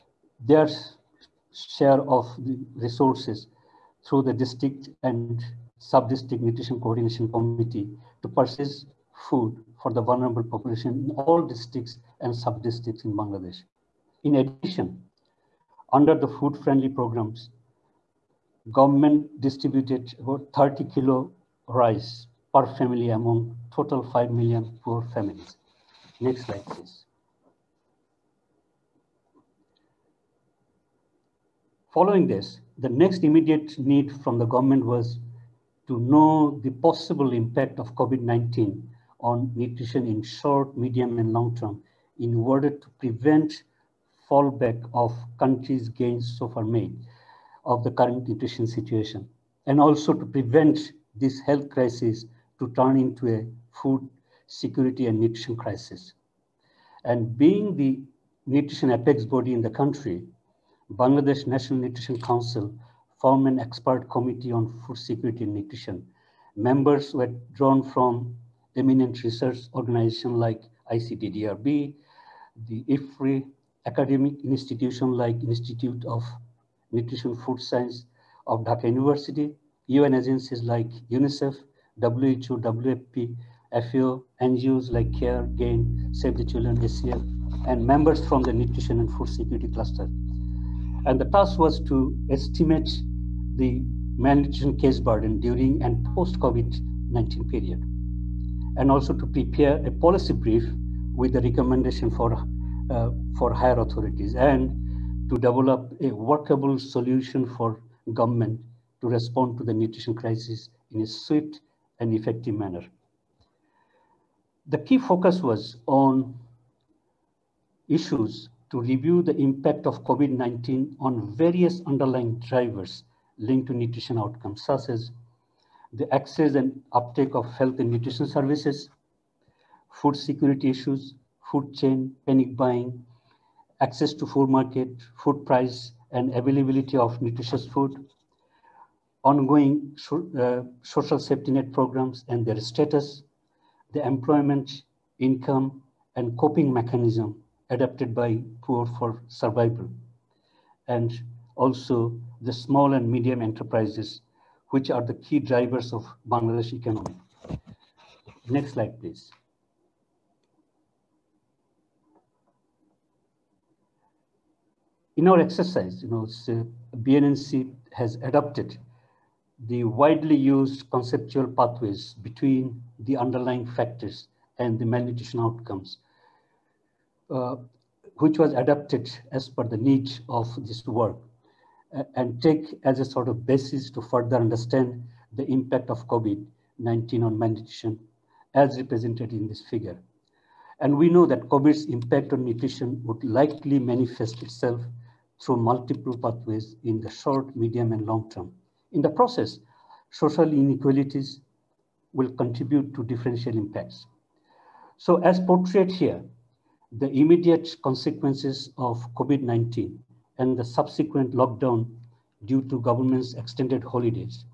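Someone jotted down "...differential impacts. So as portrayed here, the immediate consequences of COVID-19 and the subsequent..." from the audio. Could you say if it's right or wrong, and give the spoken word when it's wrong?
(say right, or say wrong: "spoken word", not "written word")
right.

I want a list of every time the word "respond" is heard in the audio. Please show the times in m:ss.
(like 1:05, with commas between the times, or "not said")
1:49.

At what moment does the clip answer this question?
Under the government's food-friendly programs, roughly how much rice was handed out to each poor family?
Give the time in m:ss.
0:20.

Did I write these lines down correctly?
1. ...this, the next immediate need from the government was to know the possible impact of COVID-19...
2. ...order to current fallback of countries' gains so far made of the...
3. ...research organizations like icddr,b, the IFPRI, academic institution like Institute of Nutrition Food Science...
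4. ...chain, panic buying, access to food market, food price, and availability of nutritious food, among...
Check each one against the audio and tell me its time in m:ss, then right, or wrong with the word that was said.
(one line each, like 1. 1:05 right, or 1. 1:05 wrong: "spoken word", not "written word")
1. 0:32 right
2. 0:42 wrong: "prevent", not "current"
3. 1:09 right
4. 2:11 wrong: "ongoing", not "among".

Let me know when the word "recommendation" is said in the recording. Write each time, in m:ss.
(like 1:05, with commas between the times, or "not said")
1:41.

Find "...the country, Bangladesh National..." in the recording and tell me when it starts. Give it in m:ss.
0:59.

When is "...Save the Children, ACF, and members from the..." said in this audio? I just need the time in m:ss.
1:26.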